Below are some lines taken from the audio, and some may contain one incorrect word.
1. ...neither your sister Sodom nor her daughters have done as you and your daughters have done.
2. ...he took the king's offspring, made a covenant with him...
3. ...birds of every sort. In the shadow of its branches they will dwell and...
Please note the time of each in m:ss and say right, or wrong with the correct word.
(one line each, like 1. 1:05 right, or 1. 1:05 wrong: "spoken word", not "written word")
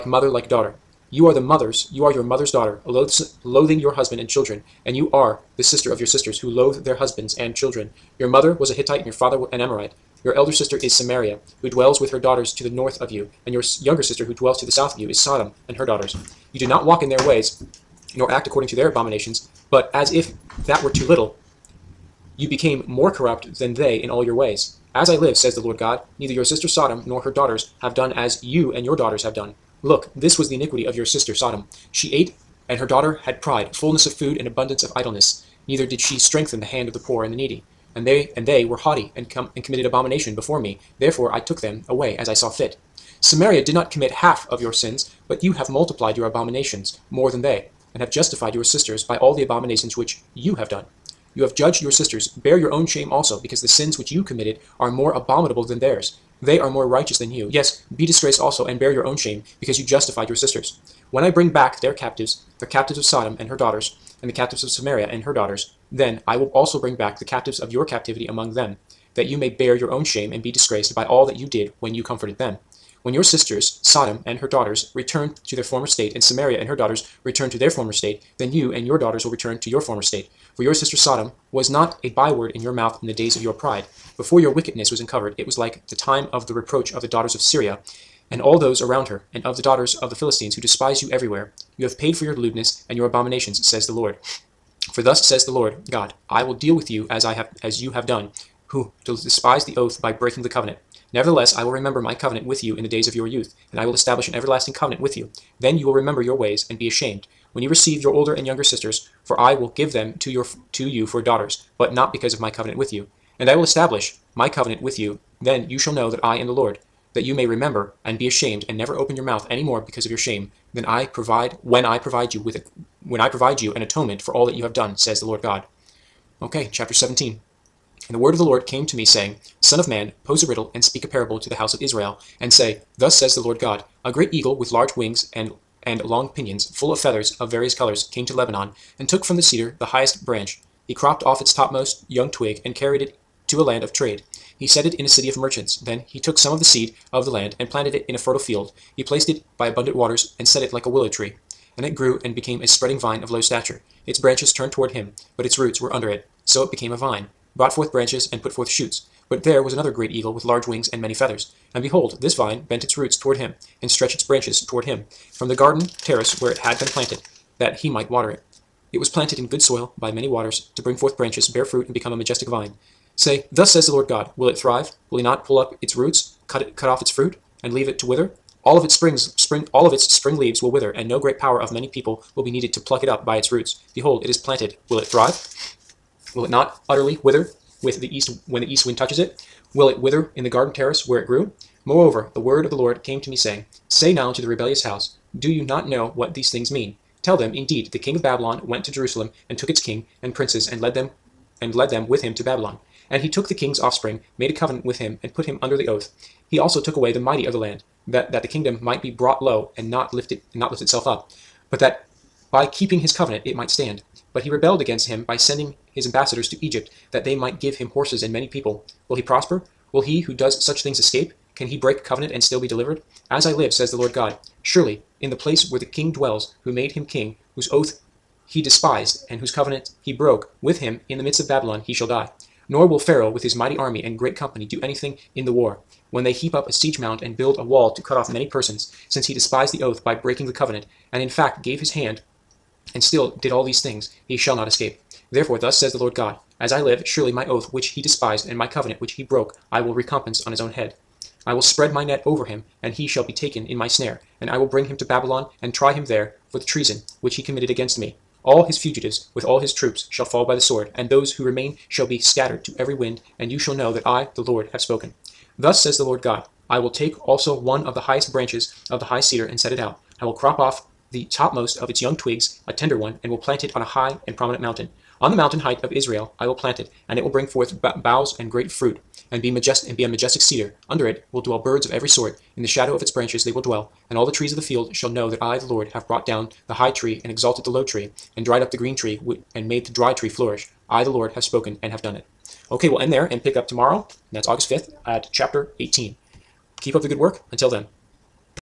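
1. 0:26 right
2. 3:23 right
3. 4:41 right.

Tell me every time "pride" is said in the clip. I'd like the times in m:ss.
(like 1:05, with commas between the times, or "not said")
0:33, 1:23.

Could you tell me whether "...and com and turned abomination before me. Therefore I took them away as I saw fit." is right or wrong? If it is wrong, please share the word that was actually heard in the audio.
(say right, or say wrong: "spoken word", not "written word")
wrong: "committed", not "turned".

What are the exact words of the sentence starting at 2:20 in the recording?
He cropped off its topmost young twig and carried it to a land of trade.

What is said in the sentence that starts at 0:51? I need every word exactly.
You have judged your sisters, bear your own shame also, because the sins which you committed are more abominable than theirs.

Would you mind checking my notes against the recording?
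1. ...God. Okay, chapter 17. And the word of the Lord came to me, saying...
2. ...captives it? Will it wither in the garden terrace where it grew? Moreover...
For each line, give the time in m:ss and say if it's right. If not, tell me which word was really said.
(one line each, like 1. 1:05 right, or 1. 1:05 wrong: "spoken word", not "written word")
1. 2:05 right
2. 3:08 wrong: "touches", not "captives".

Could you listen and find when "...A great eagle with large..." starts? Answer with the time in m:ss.
2:14.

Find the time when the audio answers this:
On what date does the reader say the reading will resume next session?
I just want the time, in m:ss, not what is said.
4:54.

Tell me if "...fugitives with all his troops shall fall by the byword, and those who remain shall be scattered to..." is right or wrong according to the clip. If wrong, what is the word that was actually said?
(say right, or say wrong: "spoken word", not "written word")
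wrong: "sword", not "byword".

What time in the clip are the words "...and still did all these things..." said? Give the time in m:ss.
4:02.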